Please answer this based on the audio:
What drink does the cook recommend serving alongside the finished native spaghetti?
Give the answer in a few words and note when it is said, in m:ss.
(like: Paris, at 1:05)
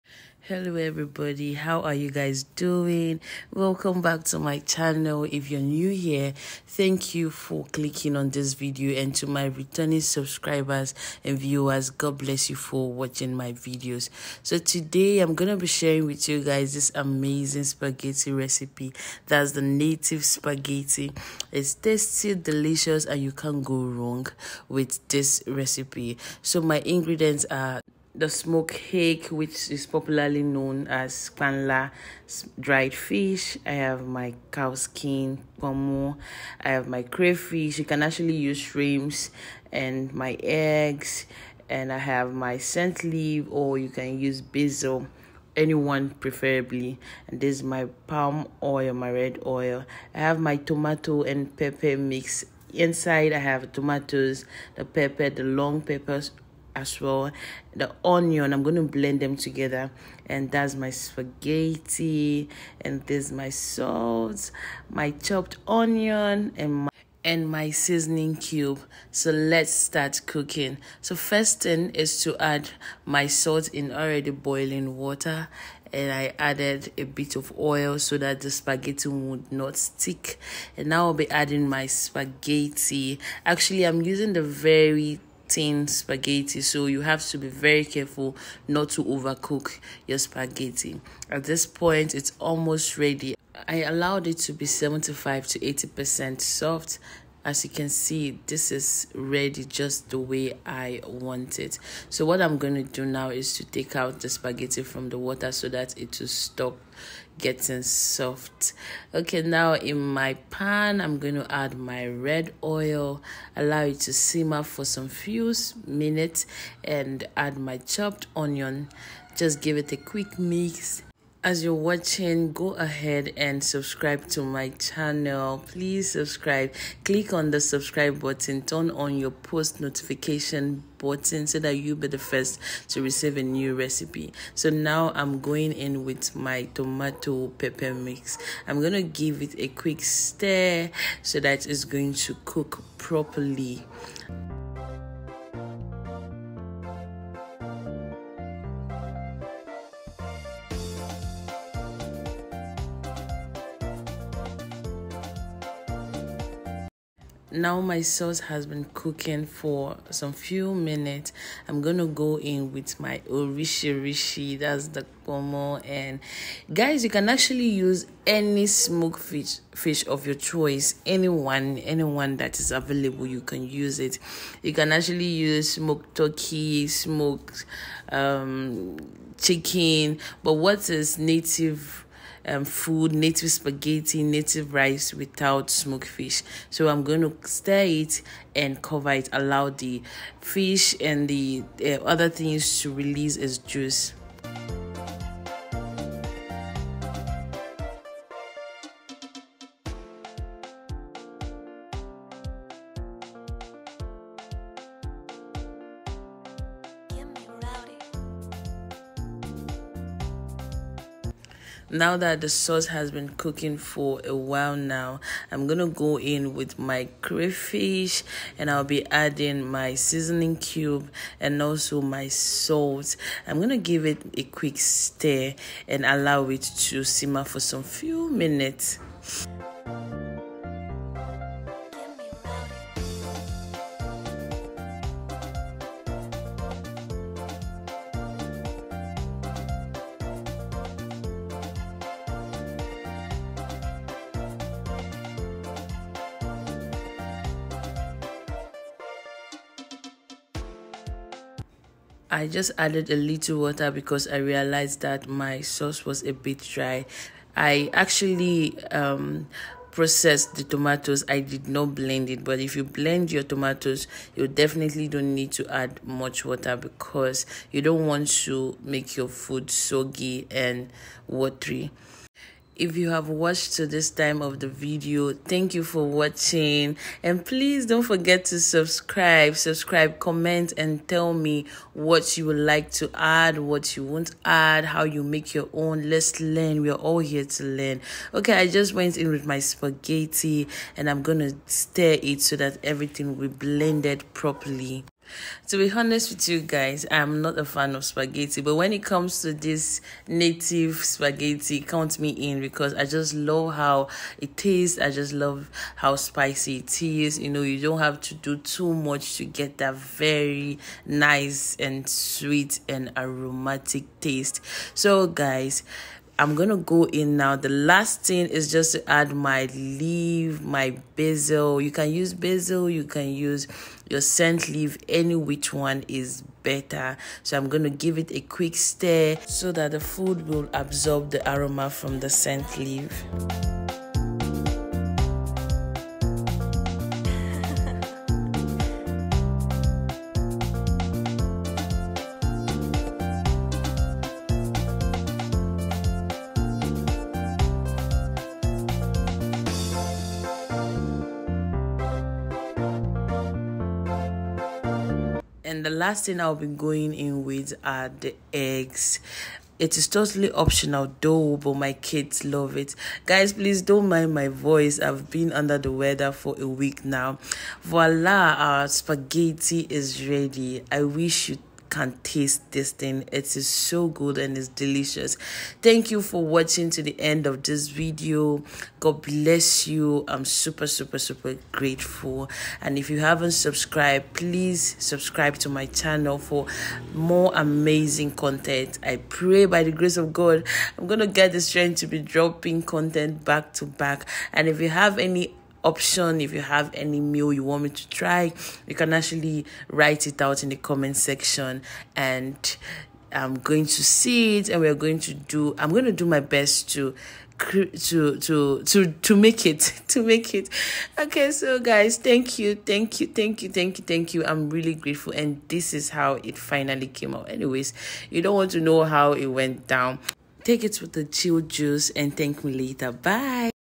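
Chill juice, at 7:01.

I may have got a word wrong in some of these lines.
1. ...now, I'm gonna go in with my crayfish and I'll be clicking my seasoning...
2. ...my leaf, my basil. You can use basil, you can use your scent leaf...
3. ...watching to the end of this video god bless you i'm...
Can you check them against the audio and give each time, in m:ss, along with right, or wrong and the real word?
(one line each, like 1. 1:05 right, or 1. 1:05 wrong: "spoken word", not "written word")
1. 3:34 wrong: "adding", not "clicking"
2. 5:19 right
3. 6:16 right.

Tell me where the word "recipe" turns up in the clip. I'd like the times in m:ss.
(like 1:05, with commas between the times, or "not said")
0:18, 0:25, 2:13.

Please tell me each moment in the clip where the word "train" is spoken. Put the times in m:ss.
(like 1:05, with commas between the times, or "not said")
not said.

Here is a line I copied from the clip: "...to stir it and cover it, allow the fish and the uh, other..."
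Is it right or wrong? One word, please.
right.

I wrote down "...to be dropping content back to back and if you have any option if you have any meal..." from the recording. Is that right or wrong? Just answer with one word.
right.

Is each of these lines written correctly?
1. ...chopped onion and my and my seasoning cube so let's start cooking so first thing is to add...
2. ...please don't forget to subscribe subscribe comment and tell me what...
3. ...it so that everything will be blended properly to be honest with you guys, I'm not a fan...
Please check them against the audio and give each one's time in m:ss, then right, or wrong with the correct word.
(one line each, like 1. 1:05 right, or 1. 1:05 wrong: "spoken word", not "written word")
1. 1:05 right
2. 4:37 right
3. 4:52 right.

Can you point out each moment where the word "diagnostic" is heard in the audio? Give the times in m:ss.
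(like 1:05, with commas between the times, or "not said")
not said.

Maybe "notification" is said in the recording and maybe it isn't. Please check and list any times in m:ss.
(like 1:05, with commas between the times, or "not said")
2:09.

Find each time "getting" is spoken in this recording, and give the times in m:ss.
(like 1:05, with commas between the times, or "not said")
1:47.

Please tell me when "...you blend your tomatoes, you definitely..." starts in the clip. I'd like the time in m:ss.
4:22.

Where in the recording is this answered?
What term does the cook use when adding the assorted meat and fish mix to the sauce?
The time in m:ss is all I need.
2:43.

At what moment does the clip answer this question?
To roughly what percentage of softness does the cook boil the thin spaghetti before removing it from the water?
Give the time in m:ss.
1:34.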